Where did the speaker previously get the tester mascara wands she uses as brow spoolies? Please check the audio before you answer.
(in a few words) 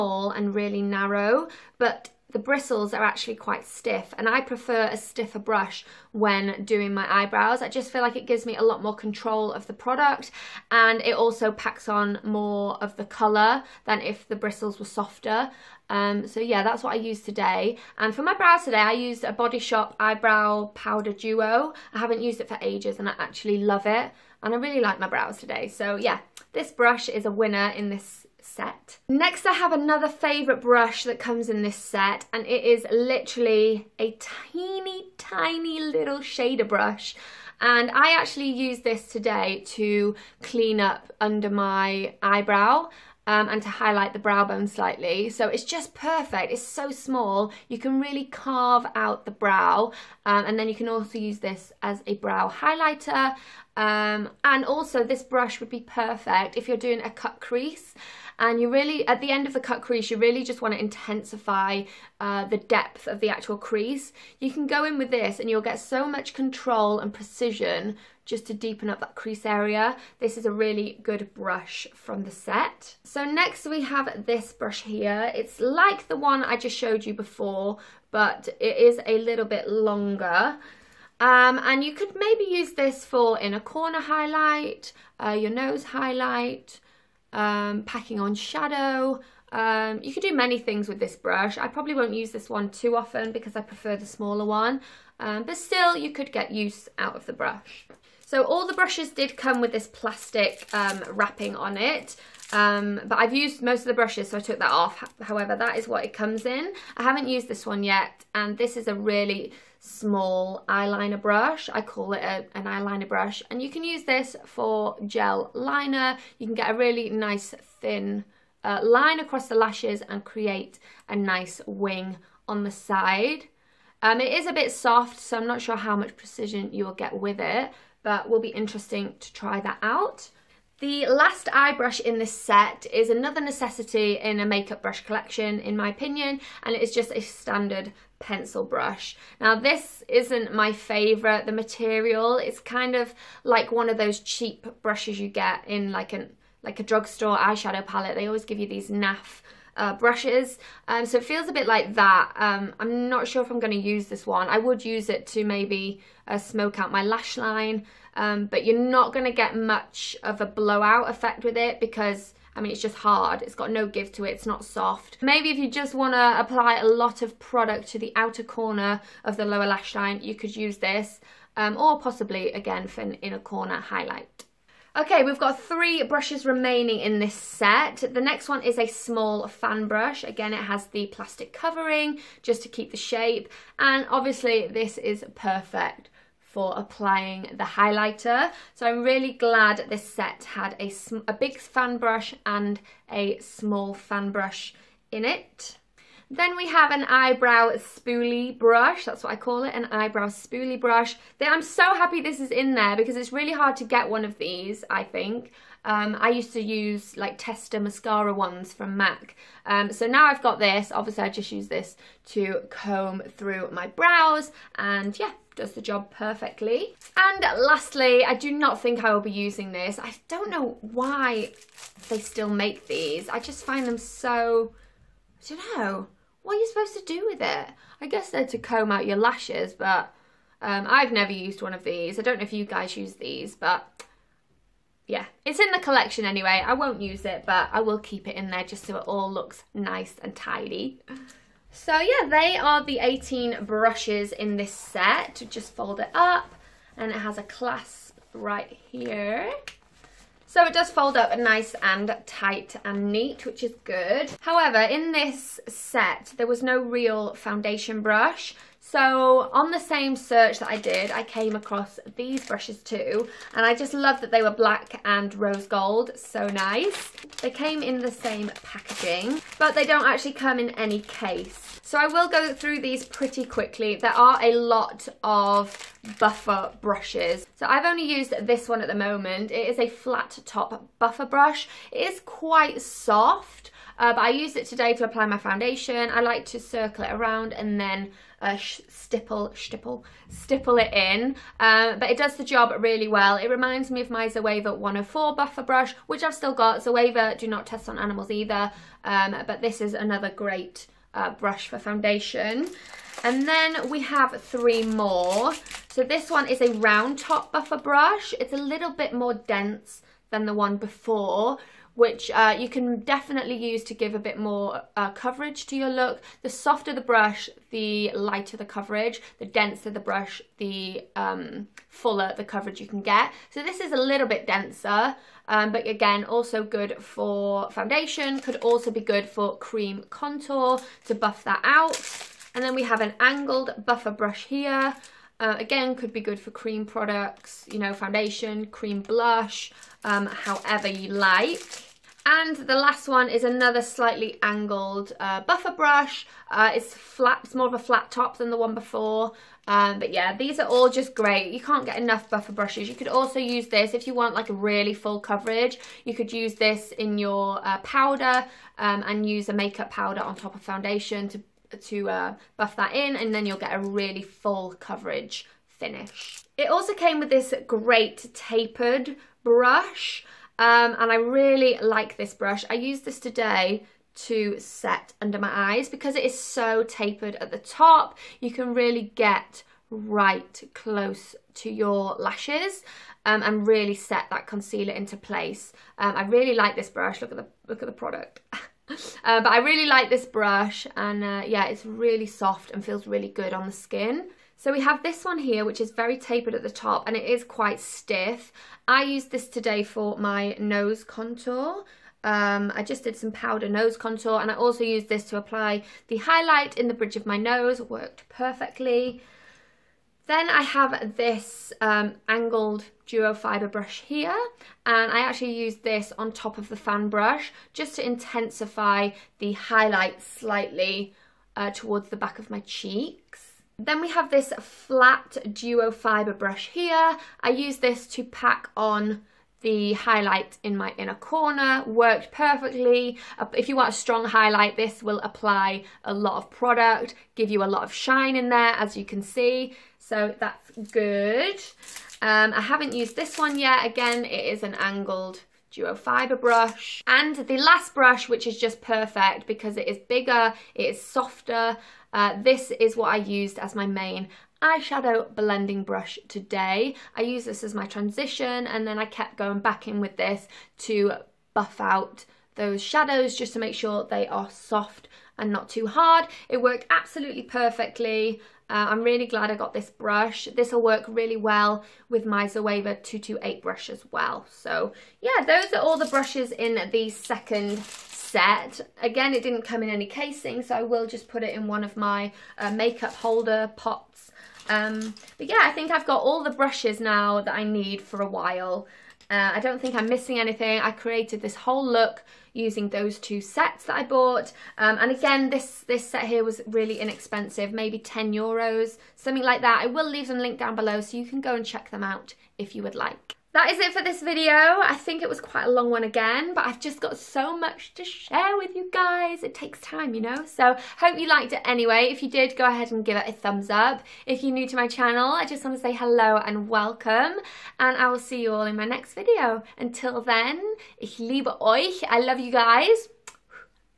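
MAC.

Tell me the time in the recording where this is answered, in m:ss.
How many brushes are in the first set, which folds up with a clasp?
4:02.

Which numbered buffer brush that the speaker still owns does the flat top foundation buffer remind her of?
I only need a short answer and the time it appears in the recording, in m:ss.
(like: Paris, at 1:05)
Zoeva 104, at 4:54.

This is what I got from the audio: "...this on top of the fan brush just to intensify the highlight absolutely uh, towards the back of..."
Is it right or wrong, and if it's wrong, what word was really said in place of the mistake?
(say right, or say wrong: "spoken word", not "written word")
wrong: "slightly", not "absolutely".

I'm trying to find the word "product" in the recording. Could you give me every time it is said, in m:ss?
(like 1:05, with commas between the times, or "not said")
0:09, 2:47, 5:36, 6:27, 7:16.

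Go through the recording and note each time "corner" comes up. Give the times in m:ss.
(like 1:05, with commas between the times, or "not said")
1:23, 2:48, 2:53, 7:11.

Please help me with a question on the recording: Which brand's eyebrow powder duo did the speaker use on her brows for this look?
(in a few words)
Body Shop.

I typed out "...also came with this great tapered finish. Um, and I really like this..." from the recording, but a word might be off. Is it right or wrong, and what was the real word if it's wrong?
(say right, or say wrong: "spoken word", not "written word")
wrong: "brush", not "finish".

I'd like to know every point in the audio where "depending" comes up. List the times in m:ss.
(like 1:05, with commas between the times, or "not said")
not said.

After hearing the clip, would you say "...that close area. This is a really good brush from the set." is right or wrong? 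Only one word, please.
wrong.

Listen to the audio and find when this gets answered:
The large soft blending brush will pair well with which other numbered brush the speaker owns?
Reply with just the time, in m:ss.
7:52.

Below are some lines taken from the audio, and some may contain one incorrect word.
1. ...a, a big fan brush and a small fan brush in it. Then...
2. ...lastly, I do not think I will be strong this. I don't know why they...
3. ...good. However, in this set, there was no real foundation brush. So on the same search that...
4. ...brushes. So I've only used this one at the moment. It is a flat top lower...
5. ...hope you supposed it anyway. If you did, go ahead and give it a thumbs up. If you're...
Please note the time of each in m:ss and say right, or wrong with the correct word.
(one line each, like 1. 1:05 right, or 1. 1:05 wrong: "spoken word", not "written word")
1. 3:10 right
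2. 3:37 wrong: "using", not "strong"
3. 4:13 right
4. 4:36 wrong: "buffer", not "lower"
5. 8:30 wrong: "liked", not "supposed".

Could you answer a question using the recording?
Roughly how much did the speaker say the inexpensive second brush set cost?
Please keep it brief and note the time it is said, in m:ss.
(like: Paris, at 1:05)
10 euros, at 8:17.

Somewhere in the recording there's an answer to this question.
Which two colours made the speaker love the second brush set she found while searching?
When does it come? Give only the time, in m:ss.
4:24.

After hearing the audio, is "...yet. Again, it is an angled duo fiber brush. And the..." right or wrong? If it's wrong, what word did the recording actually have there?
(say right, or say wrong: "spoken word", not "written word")
right.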